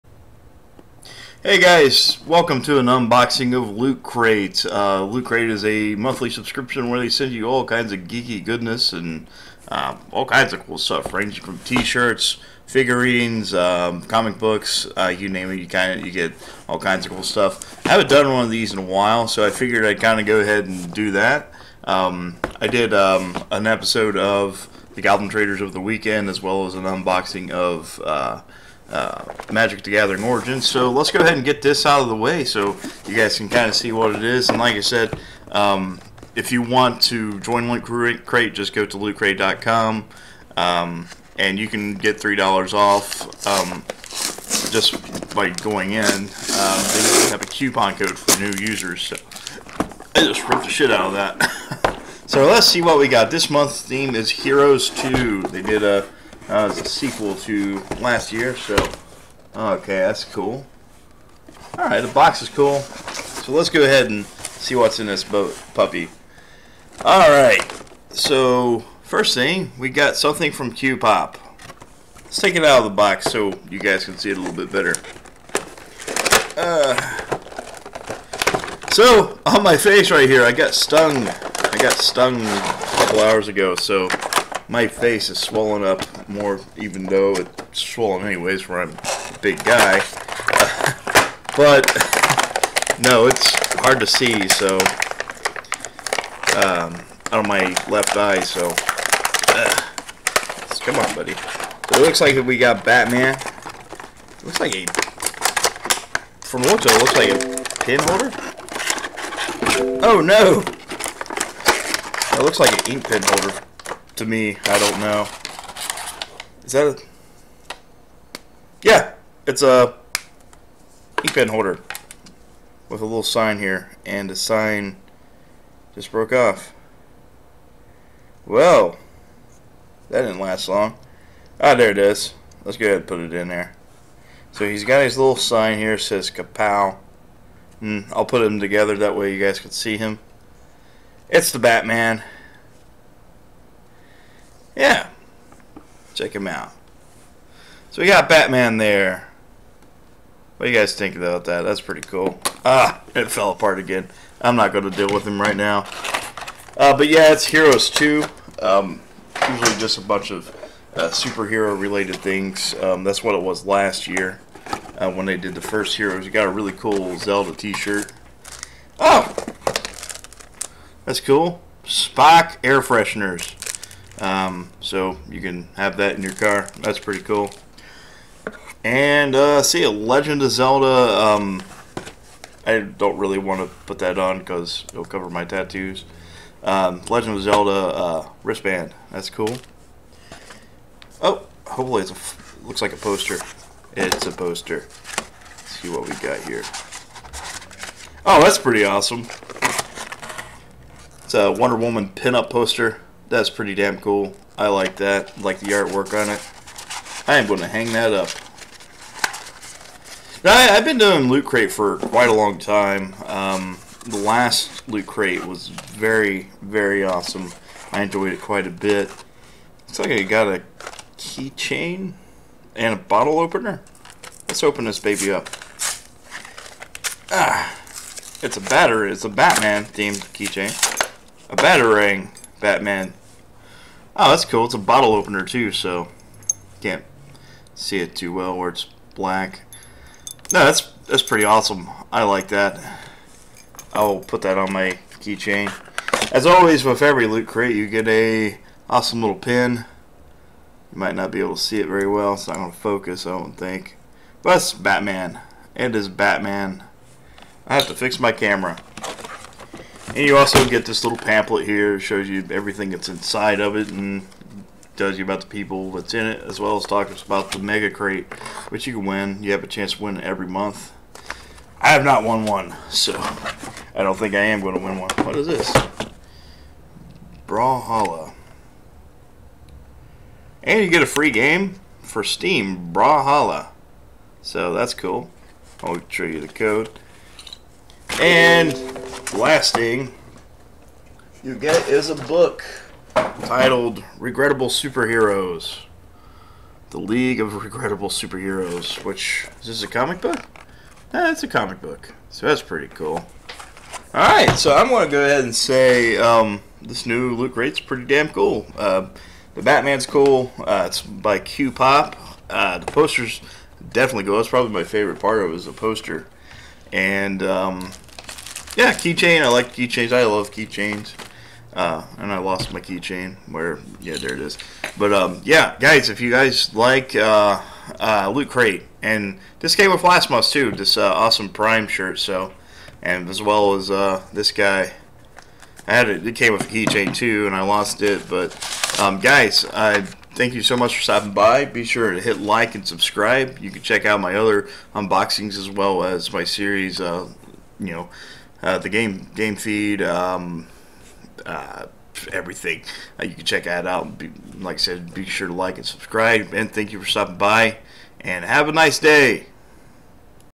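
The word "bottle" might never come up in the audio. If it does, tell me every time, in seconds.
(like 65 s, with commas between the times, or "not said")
222 s, 234 s.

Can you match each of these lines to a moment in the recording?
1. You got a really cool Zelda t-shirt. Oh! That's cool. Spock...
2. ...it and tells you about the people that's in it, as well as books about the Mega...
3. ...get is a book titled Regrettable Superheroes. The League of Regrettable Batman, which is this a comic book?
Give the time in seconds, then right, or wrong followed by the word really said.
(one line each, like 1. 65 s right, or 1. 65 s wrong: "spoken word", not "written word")
1. 166 s right
2. 263 s wrong: "talks", not "books"
3. 291 s wrong: "Superheroes", not "Batman".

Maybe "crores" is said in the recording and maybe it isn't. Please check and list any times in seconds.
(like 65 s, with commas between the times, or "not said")
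not said.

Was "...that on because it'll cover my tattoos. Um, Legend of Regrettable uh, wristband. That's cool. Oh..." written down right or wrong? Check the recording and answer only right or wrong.
wrong.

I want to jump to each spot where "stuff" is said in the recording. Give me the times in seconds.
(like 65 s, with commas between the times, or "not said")
10 s, 17 s.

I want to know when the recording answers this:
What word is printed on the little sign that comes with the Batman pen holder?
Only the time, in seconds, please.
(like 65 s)
136 s.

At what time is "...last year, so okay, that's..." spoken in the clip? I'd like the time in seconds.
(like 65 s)
58 s.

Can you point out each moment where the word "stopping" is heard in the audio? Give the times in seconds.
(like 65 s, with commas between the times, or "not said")
341 s, 357 s.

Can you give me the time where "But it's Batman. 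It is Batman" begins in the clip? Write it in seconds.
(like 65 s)
254 s.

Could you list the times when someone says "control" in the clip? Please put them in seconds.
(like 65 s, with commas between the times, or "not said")
not said.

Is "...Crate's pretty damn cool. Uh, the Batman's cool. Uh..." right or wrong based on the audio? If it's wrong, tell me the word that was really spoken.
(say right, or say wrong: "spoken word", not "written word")
right.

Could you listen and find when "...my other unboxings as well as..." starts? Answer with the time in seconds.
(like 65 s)
344 s.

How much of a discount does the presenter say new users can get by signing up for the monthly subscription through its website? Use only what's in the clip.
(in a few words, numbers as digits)
$3.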